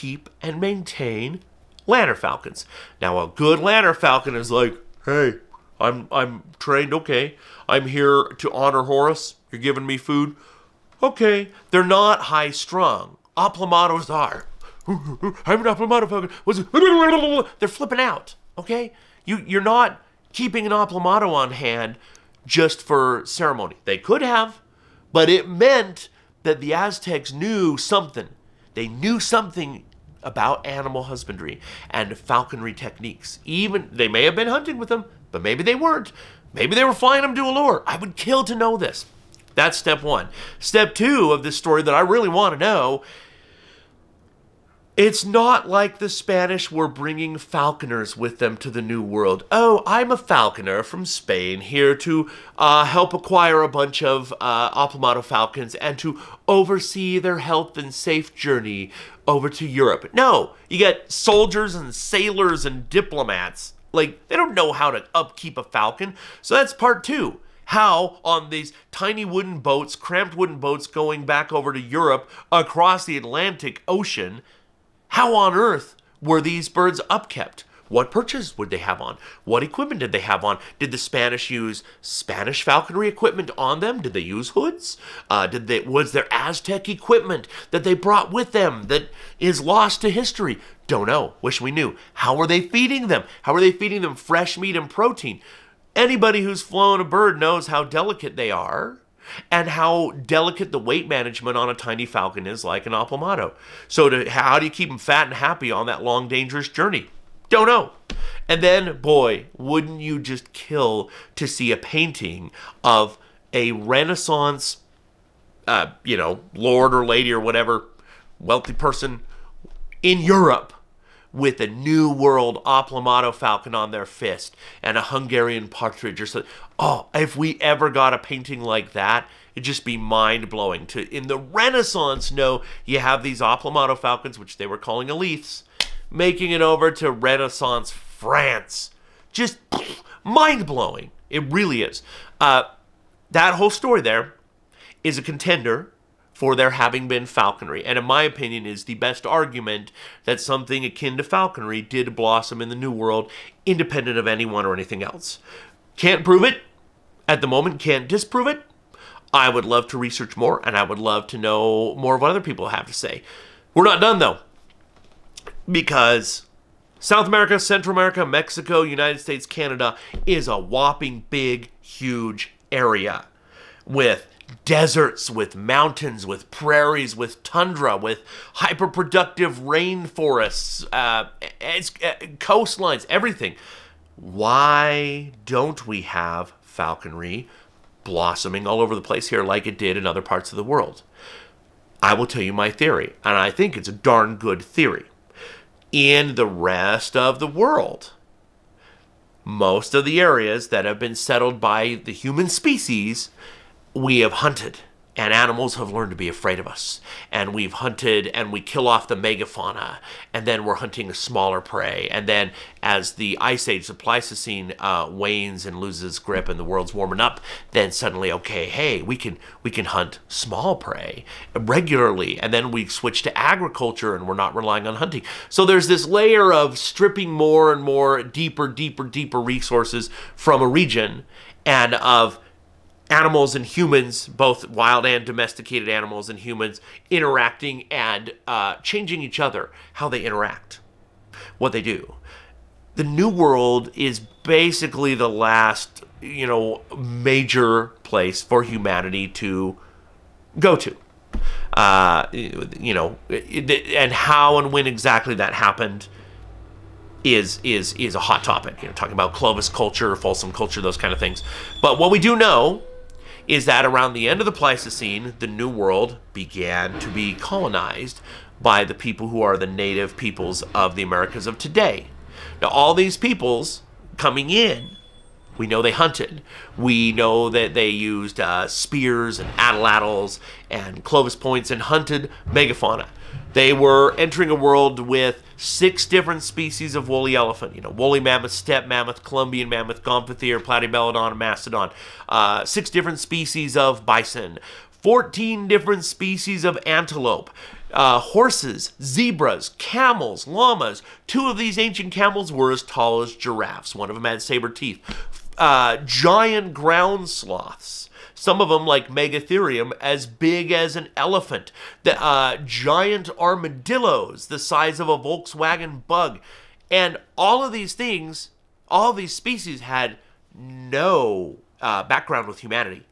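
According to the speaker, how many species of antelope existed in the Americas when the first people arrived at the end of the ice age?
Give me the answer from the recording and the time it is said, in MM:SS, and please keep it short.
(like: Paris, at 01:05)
14, at 04:55.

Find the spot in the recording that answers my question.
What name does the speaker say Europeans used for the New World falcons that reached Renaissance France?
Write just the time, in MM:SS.
02:15.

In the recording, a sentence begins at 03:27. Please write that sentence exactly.
And we've hunted and we kill off the megafauna, and then we're hunting a smaller prey.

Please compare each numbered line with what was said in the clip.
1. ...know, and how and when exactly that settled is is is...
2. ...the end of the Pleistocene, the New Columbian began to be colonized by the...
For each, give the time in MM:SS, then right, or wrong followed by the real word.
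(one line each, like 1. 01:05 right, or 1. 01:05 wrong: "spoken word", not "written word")
1. 04:12 wrong: "happened", not "settled"
2. 04:24 wrong: "World", not "Columbian".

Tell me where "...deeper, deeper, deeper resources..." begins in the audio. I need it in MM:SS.
03:48.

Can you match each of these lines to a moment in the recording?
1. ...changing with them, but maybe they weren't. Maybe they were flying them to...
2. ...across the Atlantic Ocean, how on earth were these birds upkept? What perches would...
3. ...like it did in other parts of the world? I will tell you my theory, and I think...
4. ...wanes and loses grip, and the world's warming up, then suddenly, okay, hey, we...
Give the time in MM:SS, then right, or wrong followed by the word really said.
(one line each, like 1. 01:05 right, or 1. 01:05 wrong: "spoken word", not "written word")
1. 00:34 wrong: "hunting", not "changing"
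2. 01:12 right
3. 03:09 right
4. 03:35 right.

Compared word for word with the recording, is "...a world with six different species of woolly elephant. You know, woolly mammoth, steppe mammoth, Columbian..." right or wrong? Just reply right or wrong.
right.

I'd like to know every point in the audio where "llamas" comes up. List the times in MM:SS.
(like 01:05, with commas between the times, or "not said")
05:00.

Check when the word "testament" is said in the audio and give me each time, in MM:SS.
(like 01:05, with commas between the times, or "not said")
not said.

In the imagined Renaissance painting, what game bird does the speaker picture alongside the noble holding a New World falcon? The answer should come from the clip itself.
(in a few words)
Hungarian partridge.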